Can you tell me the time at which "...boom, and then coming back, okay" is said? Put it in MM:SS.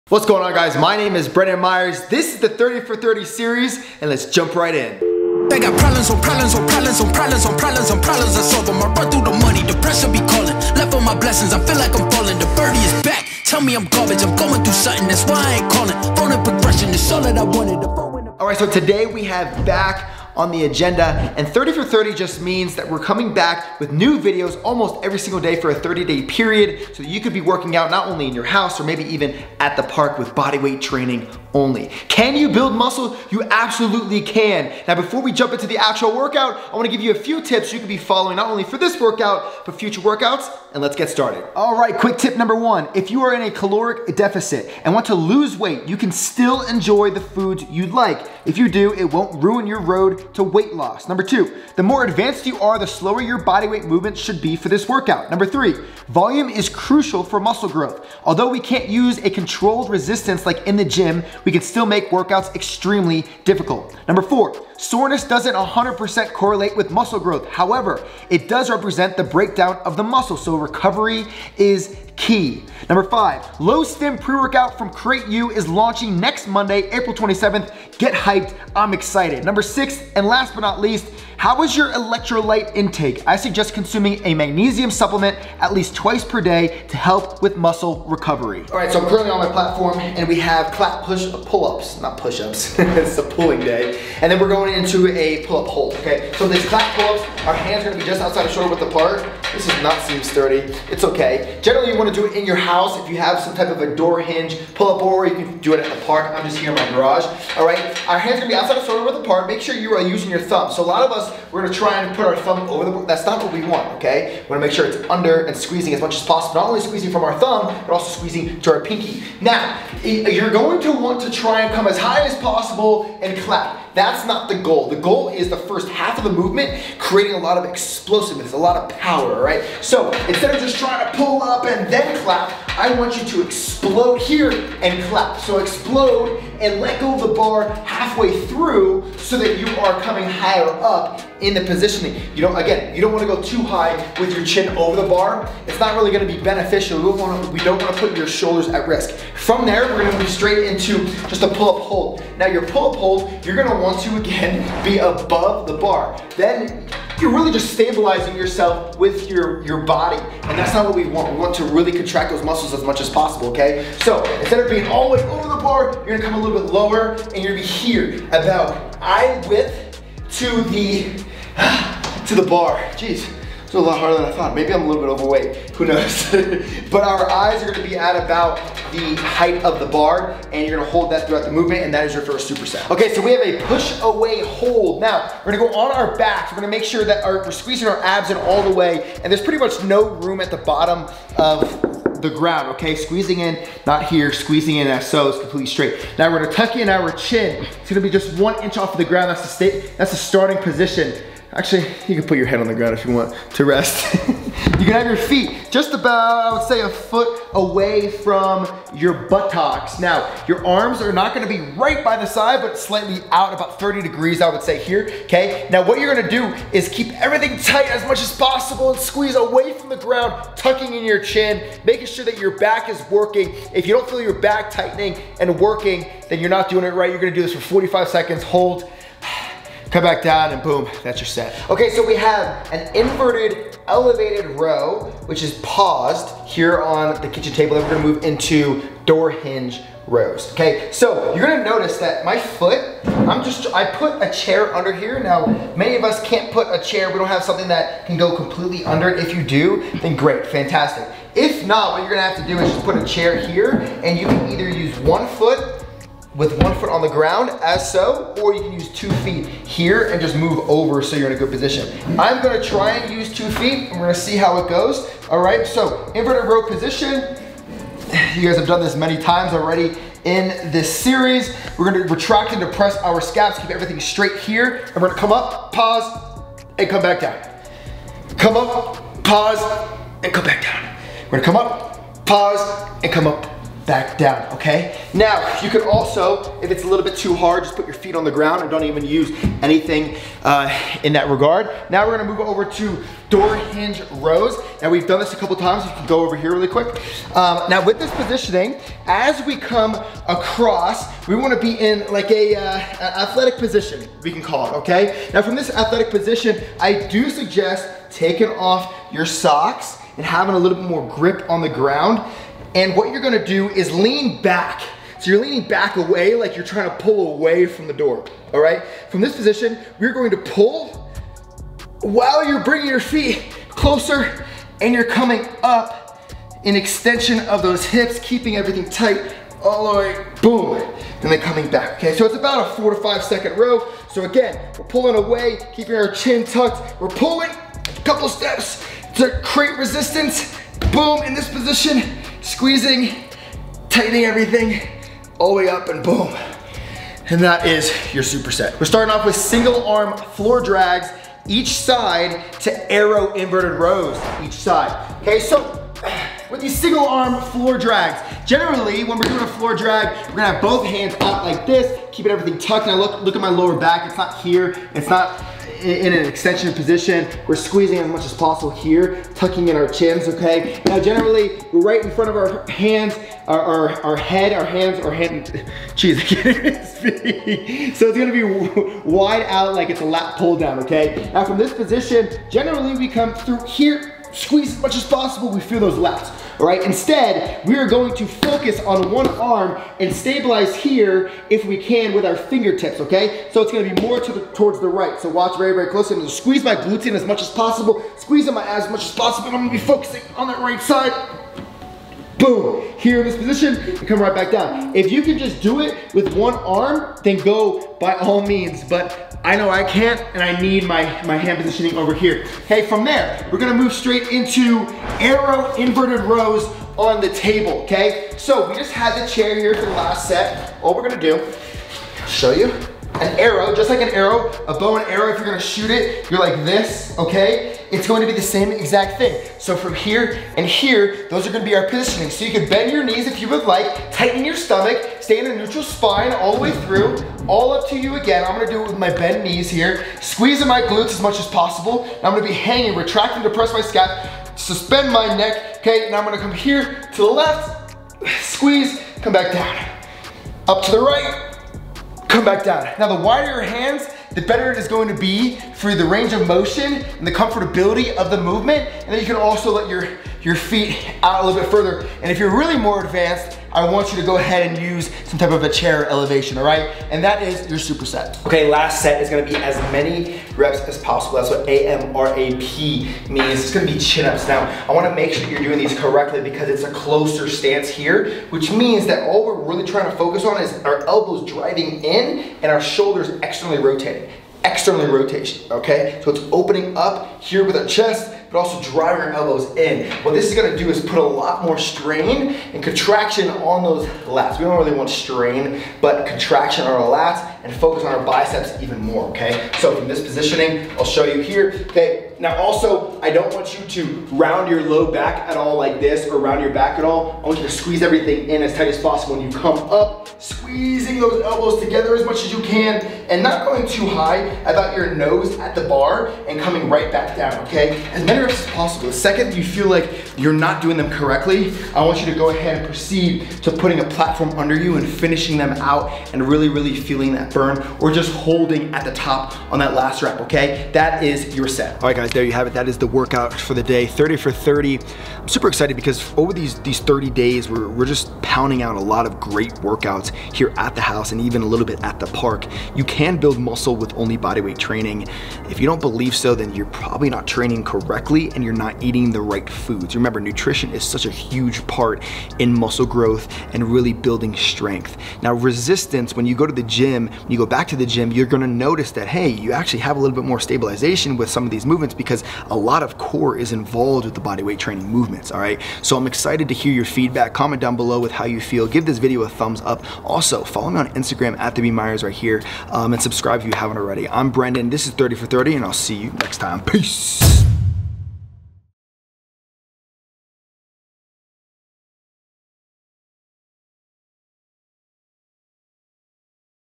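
05:30.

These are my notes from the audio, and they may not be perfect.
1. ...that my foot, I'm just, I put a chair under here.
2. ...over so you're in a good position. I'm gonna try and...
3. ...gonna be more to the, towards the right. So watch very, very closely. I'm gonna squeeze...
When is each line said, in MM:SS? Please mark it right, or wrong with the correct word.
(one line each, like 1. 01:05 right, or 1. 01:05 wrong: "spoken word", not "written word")
1. 04:01 right
2. 04:20 right
3. 06:33 right.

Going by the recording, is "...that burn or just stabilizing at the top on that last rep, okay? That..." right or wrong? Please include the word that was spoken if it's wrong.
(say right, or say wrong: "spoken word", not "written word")
wrong: "holding", not "stabilizing".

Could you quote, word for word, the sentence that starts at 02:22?
You don't, again, you don't wanna go too high with your chin over the bar.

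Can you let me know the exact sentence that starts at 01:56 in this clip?
Not only squeezing from our thumb, but also squeezing to our pinky.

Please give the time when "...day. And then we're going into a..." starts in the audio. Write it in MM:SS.
01:33.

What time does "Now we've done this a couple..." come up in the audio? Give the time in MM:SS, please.
04:54.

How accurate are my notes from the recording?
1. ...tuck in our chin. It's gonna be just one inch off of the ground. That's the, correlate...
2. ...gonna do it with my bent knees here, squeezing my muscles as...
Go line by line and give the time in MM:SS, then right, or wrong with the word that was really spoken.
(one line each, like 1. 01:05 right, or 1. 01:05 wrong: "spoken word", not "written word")
1. 03:16 wrong: "state", not "correlate"
2. 07:18 wrong: "glutes", not "muscles".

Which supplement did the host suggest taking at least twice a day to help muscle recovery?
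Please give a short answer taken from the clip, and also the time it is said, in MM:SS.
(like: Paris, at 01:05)
magnesium, at 01:24.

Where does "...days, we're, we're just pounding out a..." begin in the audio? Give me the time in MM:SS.
08:57.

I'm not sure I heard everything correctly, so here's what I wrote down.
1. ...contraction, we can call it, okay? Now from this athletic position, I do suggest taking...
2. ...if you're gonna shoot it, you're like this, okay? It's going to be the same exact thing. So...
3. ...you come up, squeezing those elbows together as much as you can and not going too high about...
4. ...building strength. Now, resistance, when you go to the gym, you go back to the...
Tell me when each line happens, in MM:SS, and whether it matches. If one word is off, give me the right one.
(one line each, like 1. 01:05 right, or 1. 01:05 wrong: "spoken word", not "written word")
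1. 05:03 wrong: "position", not "contraction"
2. 07:05 right
3. 08:29 right
4. 09:14 right.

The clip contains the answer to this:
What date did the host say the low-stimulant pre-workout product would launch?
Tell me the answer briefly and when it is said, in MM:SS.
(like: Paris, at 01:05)
April 27th, at 01:16.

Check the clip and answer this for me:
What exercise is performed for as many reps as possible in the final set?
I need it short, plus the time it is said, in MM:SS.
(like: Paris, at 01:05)
chin-ups, at 07:53.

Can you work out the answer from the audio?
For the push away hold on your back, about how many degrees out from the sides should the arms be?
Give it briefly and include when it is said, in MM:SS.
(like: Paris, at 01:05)
30, at 03:33.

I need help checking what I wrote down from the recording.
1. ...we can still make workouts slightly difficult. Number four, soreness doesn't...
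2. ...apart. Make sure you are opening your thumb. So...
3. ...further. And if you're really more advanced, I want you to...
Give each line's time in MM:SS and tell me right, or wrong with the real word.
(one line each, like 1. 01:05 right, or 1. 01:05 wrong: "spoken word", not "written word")
1. 01:01 wrong: "extremely", not "slightly"
2. 01:49 wrong: "using", not "opening"
3. 07:41 right.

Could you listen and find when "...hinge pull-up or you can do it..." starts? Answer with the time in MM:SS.
01:44.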